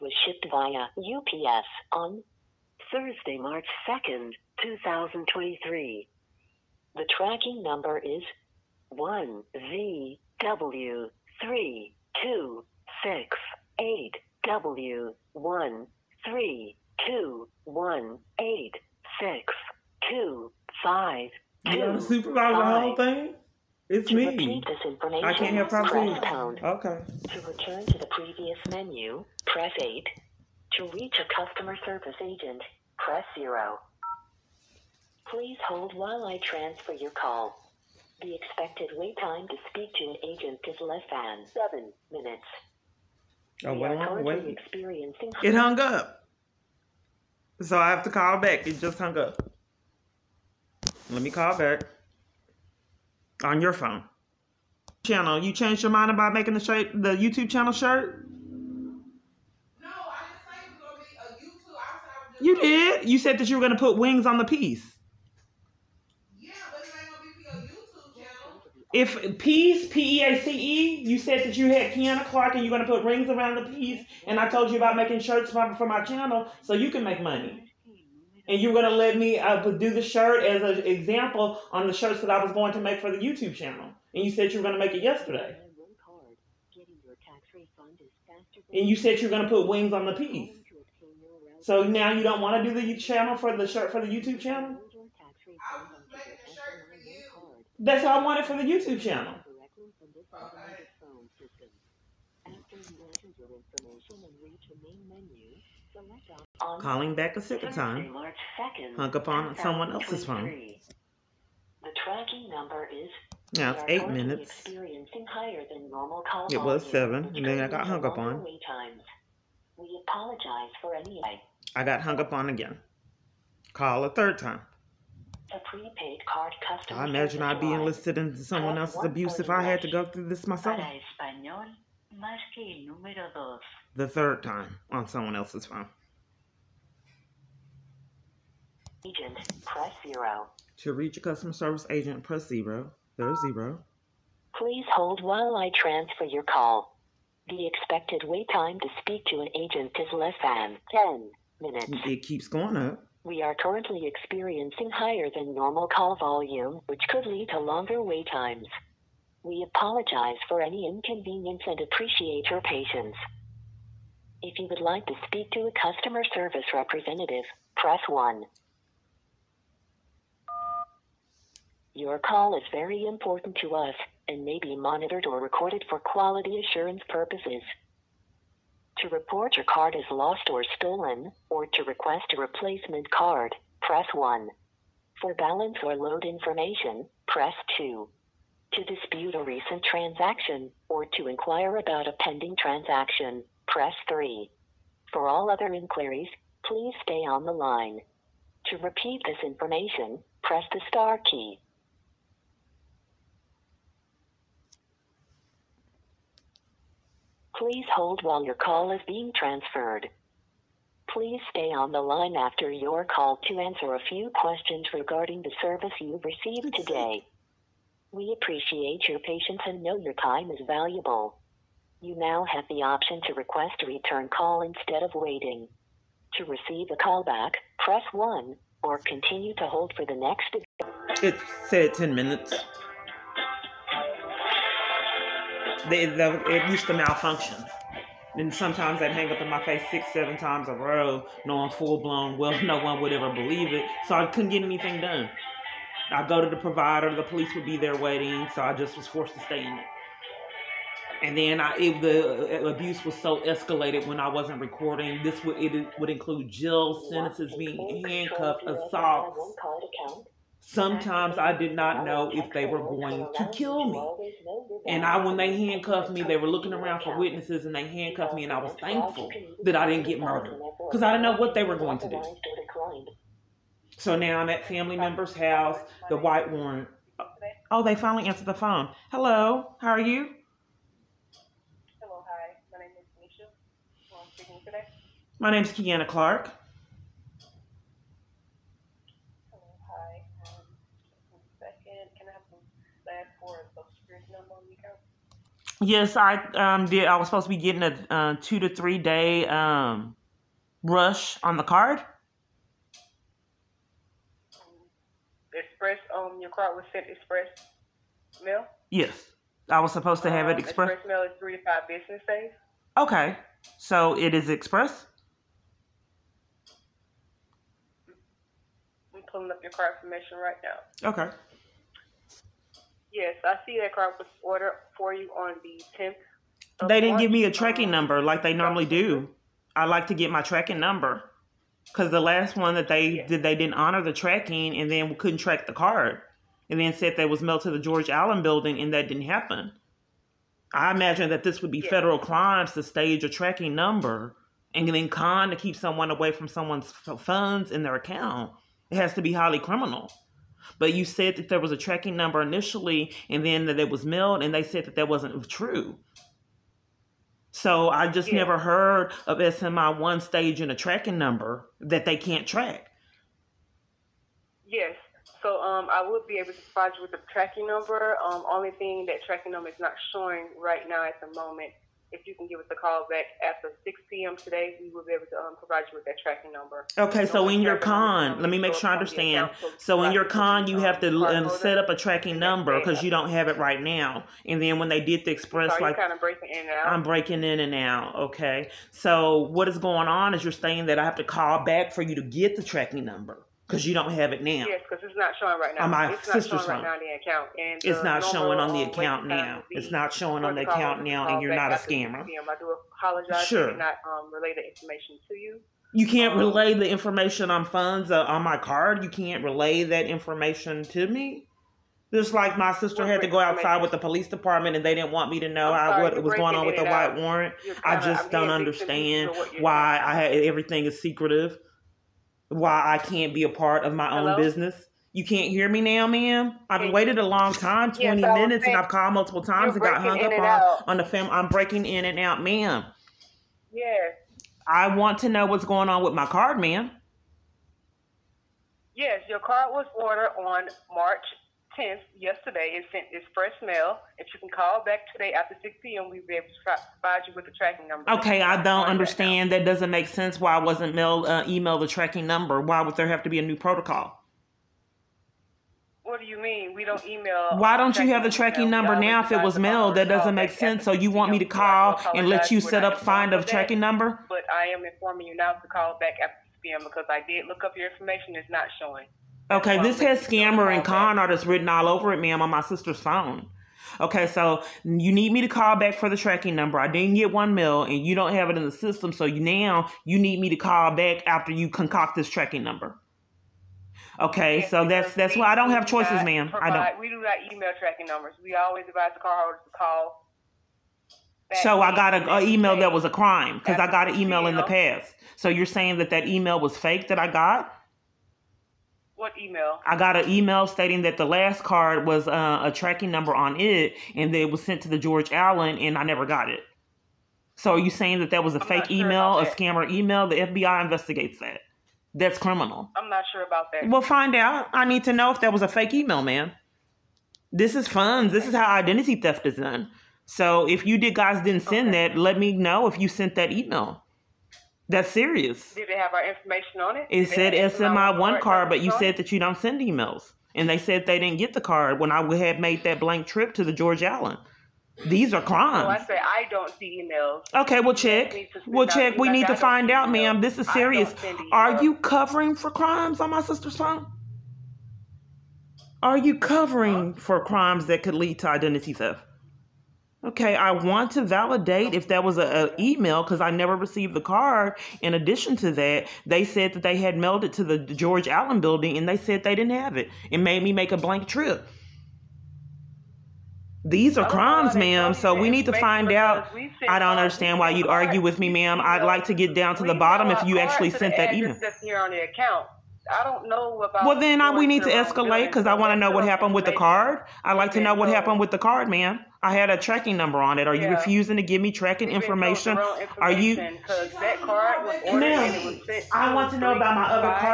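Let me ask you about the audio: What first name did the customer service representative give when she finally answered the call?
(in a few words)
Keisha.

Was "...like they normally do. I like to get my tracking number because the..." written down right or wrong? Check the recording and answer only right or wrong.
right.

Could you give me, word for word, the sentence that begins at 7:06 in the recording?
I've waited a long time, 20 yeah, so minutes, and I've called multiple times and got hung up on, on the fam.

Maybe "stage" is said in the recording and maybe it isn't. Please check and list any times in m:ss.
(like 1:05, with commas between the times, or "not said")
5:42, 6:00.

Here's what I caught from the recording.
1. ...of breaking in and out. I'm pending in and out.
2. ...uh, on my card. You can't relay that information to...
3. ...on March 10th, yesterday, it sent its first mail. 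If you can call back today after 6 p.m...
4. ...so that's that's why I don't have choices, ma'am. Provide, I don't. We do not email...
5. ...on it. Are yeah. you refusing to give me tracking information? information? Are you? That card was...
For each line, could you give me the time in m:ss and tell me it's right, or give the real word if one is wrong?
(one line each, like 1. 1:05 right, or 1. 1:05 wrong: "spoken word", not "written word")
1. 6:26 wrong: "breaking", not "pending"
2. 6:48 right
3. 7:20 right
4. 8:04 right
5. 9:40 right.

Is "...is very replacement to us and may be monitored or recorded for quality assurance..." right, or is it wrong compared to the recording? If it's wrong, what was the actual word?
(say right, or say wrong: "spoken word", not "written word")
wrong: "important", not "replacement".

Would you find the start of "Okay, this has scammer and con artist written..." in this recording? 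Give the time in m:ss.
7:49.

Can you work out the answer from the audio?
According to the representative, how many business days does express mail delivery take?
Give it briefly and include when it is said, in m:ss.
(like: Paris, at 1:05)
3 to 5, at 5:11.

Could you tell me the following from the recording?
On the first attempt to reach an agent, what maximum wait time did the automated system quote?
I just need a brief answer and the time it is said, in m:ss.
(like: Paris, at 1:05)
7 minutes, at 0:40.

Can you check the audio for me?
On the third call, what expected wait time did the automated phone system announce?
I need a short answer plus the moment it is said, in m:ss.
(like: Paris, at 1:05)
10 minutes, at 2:30.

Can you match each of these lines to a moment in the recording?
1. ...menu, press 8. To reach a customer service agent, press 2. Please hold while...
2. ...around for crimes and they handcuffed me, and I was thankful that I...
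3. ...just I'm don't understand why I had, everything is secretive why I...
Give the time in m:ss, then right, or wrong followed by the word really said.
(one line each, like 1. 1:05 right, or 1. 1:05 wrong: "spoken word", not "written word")
1. 0:28 wrong: "0", not "2"
2. 4:26 wrong: "witnesses", not "crimes"
3. 6:57 right.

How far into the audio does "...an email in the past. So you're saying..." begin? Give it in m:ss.
8:14.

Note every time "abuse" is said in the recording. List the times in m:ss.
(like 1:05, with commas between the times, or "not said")
2:09, 4:12.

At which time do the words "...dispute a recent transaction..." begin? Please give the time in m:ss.
3:08.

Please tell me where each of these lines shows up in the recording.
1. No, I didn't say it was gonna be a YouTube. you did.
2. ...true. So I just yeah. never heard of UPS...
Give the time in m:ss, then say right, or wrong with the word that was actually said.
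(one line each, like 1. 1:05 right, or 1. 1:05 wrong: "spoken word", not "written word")
1. 0:59 right
2. 5:55 wrong: "SMI", not "UPS".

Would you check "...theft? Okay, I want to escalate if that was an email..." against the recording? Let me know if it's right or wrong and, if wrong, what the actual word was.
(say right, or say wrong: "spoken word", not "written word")
wrong: "validate", not "escalate".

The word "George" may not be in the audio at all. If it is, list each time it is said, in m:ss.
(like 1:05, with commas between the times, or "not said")
5:37, 8:24, 8:53, 9:17.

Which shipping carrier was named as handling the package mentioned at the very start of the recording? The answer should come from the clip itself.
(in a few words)
UPS.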